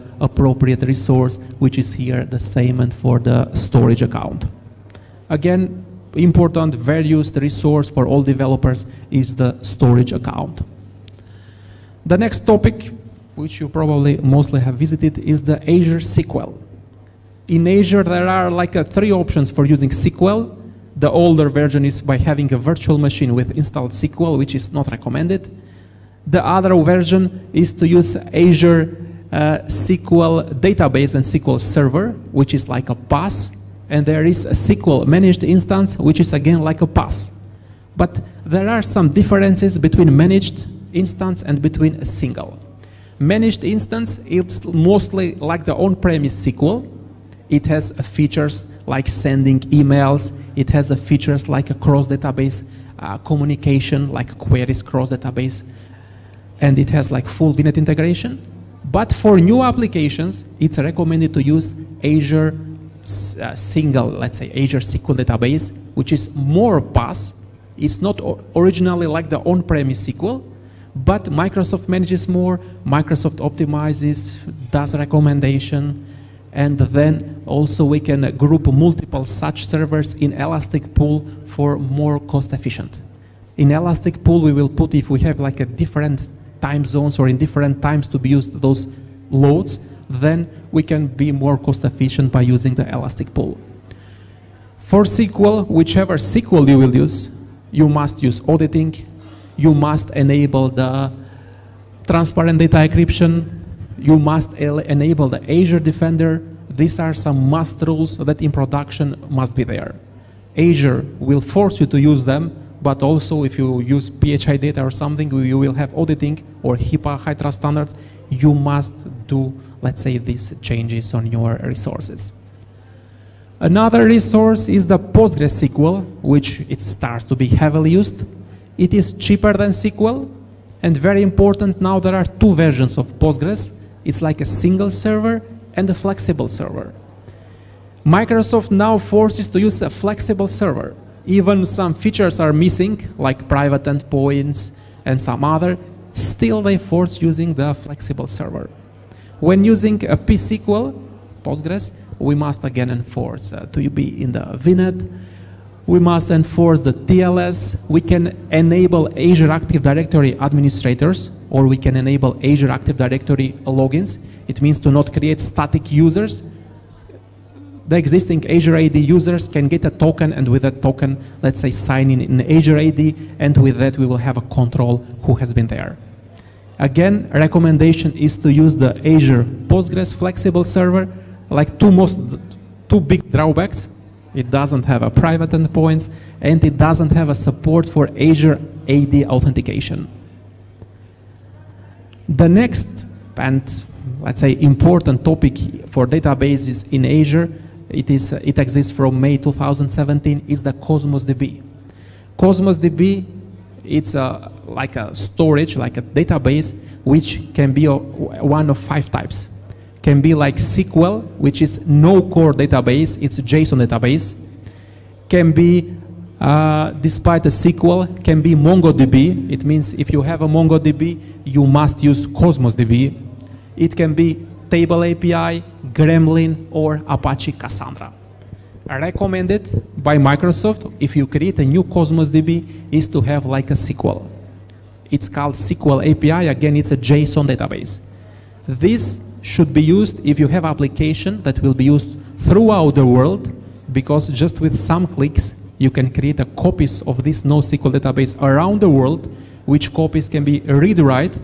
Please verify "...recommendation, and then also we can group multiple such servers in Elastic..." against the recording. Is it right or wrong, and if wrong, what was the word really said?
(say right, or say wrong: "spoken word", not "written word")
right.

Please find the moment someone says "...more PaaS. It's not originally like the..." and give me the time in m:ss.
1:06.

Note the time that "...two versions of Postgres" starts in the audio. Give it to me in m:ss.
2:12.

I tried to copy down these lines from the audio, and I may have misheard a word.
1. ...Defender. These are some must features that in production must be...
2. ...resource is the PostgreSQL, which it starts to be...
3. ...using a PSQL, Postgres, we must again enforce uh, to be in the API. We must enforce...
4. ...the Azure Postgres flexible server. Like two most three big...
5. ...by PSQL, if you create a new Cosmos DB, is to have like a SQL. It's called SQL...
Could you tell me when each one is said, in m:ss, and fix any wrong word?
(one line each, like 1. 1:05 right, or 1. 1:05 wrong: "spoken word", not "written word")
1. 1:45 wrong: "rules", not "features"
2. 2:04 right
3. 2:29 wrong: "VNet", not "API"
4. 2:58 wrong: "two", not "three"
5. 3:50 wrong: "Microsoft", not "PSQL".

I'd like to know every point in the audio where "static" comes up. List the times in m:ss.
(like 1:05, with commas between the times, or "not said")
2:45.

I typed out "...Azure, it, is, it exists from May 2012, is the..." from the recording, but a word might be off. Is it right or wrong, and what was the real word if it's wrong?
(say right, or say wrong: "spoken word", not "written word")
wrong: "2017", not "2012".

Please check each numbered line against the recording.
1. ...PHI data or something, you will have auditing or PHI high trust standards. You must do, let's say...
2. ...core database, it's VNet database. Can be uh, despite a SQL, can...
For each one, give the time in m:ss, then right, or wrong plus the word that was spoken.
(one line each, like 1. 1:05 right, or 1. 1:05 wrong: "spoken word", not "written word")
1. 1:54 wrong: "HIPAA", not "PHI"
2. 3:32 wrong: "JSON", not "VNet".